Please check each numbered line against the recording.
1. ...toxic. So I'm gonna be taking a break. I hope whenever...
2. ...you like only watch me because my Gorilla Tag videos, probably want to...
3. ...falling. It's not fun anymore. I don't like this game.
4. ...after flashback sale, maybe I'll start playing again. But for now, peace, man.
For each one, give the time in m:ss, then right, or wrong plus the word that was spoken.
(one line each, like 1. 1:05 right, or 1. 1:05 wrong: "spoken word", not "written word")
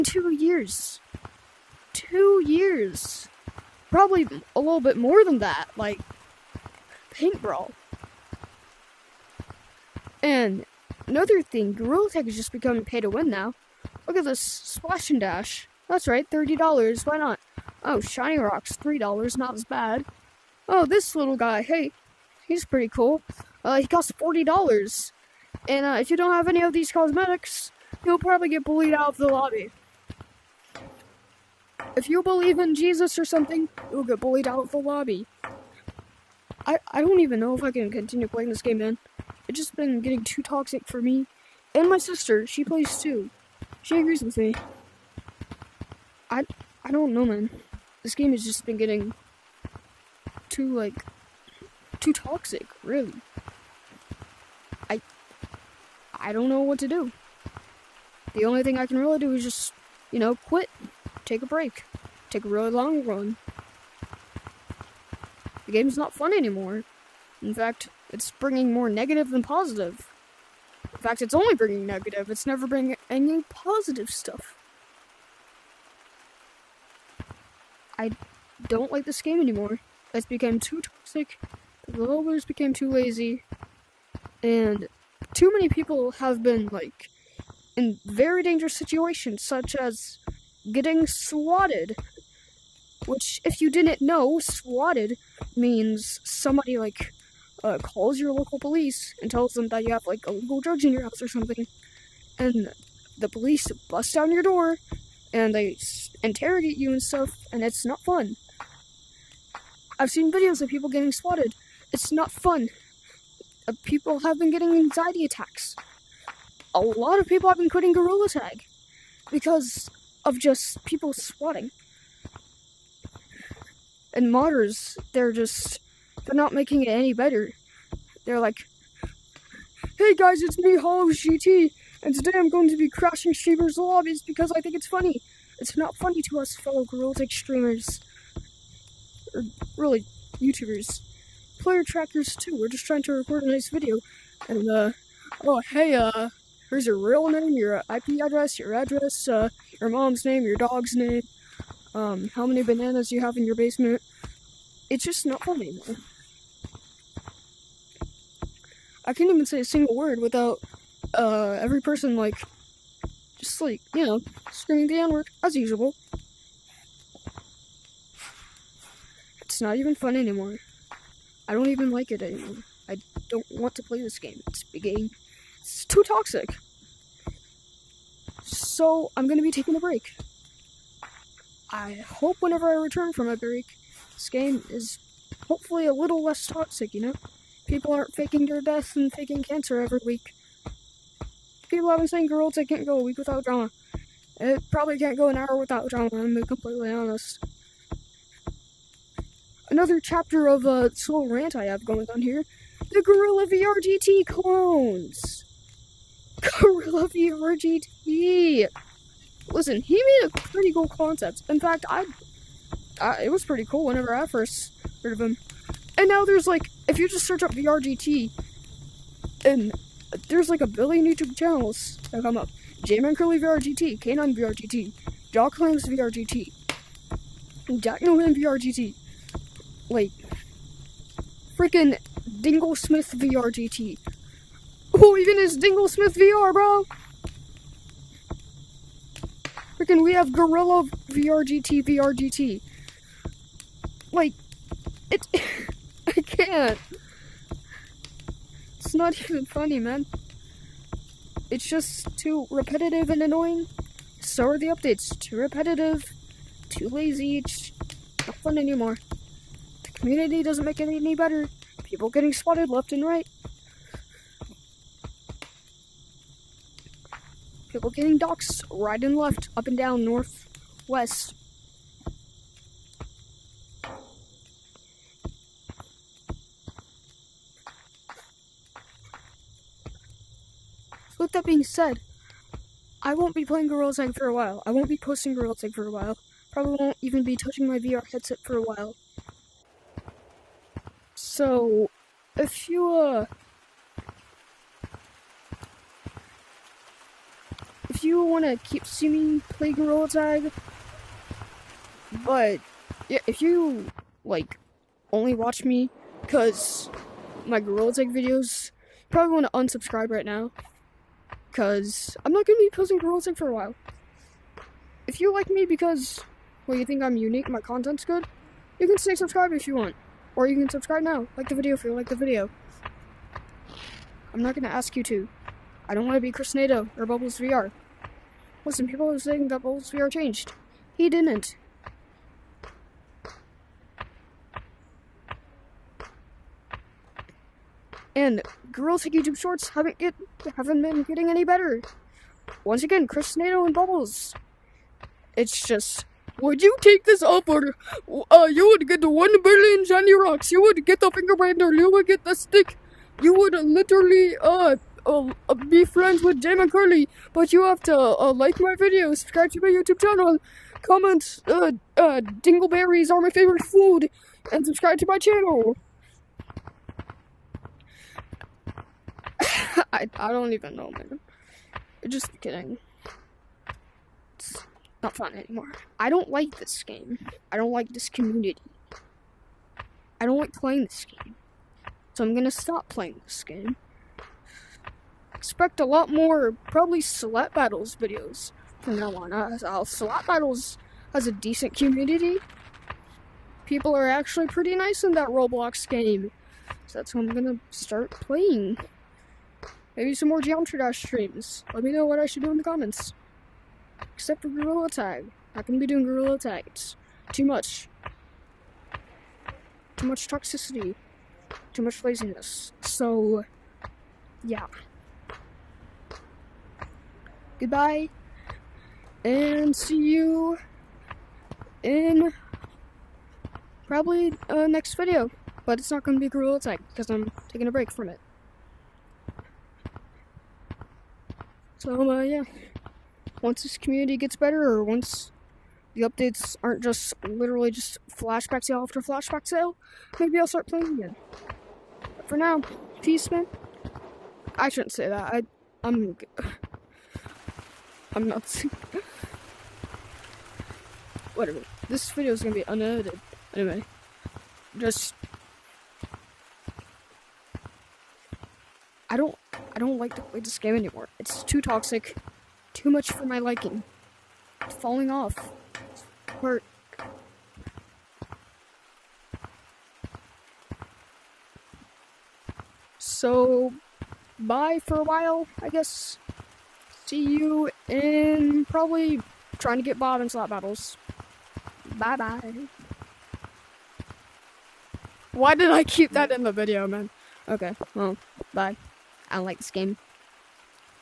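1. 2:56 right
2. 5:03 right
3. 6:12 wrong: "kidding", not "falling"
4. 7:18 right.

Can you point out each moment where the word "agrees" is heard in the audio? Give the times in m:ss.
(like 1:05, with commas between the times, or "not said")
0:43.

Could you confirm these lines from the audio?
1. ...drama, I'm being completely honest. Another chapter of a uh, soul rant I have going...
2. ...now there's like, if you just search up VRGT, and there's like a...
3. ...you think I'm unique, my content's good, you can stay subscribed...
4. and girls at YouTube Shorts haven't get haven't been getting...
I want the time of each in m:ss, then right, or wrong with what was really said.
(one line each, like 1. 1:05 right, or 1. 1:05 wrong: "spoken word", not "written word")
1. 3:15 right
2. 3:36 right
3. 5:16 right
4. 5:38 right.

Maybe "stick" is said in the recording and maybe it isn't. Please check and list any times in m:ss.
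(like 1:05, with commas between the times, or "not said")
5:52.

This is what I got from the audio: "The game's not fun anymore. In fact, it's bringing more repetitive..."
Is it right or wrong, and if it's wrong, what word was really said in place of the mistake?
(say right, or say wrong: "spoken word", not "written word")
wrong: "negative", not "repetitive".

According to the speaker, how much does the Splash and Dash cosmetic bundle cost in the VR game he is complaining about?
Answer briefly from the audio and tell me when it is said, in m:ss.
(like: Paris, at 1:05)
$30, at 0:16.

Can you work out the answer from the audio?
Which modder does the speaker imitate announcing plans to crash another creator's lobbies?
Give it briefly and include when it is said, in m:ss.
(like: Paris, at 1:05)
Hollow GT, at 2:10.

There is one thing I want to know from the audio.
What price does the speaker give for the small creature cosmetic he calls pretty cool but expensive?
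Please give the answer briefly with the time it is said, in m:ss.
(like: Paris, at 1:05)
$40, at 0:24.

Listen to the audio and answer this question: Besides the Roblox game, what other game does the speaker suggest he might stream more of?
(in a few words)
Geometry Dash.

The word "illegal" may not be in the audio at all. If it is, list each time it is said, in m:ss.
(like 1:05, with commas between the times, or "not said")
1:40.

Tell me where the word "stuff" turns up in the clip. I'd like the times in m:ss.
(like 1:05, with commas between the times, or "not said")
1:14, 1:47.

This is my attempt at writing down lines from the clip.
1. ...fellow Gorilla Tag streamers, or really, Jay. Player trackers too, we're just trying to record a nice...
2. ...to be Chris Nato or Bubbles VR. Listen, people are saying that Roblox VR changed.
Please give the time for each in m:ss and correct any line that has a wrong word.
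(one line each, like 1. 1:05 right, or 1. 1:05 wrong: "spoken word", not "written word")
1. 2:16 wrong: "YouTubers", not "Jay"
2. 5:26 wrong: "Bubbles", not "Roblox".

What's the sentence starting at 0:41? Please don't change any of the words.
And my sister, she plays too.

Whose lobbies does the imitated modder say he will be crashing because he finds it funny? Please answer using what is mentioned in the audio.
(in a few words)
Sheever.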